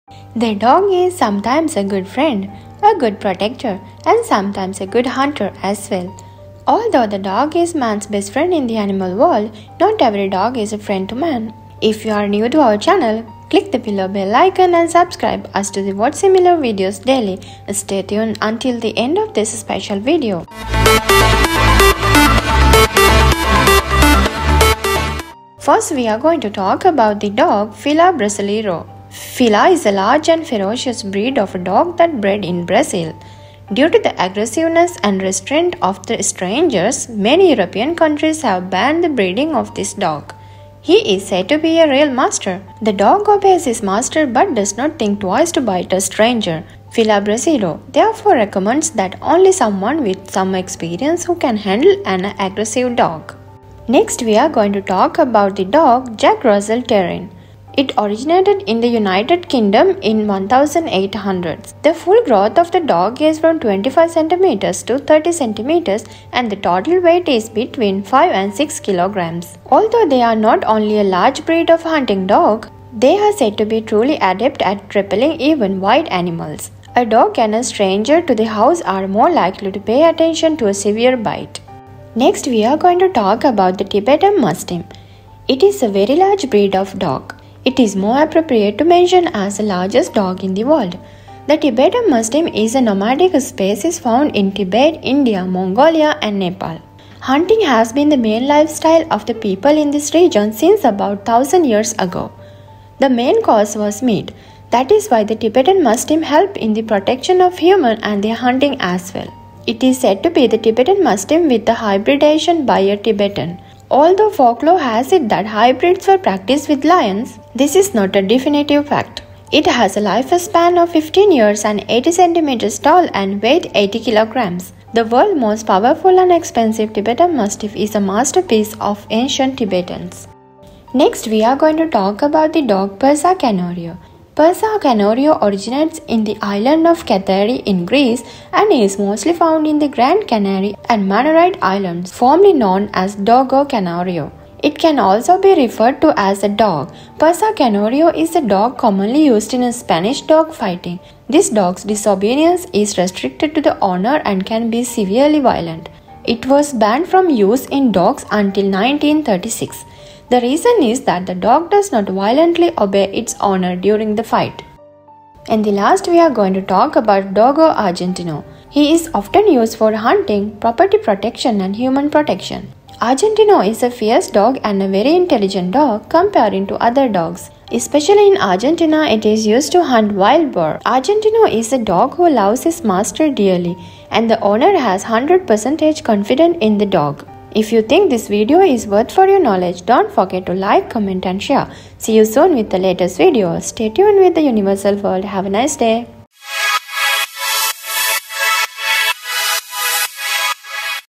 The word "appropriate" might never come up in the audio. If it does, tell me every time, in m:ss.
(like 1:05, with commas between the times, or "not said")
1:28.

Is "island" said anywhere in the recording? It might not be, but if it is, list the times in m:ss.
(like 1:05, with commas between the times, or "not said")
2:16, 2:21.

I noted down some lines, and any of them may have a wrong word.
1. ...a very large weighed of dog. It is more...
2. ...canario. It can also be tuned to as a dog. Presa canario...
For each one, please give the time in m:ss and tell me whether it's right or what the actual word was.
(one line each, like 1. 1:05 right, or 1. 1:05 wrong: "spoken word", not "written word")
1. 1:25 wrong: "breed", not "weighed"
2. 2:23 wrong: "referred", not "tuned".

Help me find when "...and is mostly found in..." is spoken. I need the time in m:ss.
2:18.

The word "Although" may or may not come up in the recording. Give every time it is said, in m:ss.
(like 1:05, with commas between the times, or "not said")
0:06, 1:09, 1:53.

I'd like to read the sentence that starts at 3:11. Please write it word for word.
See you soon with the latest video.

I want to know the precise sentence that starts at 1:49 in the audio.
It is said to be the Tibetan Mastiff with the hybridization by a Tibetan.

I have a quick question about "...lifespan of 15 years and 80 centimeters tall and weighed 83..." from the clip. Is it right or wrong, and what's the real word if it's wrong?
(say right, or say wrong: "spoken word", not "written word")
wrong: "80", not "83".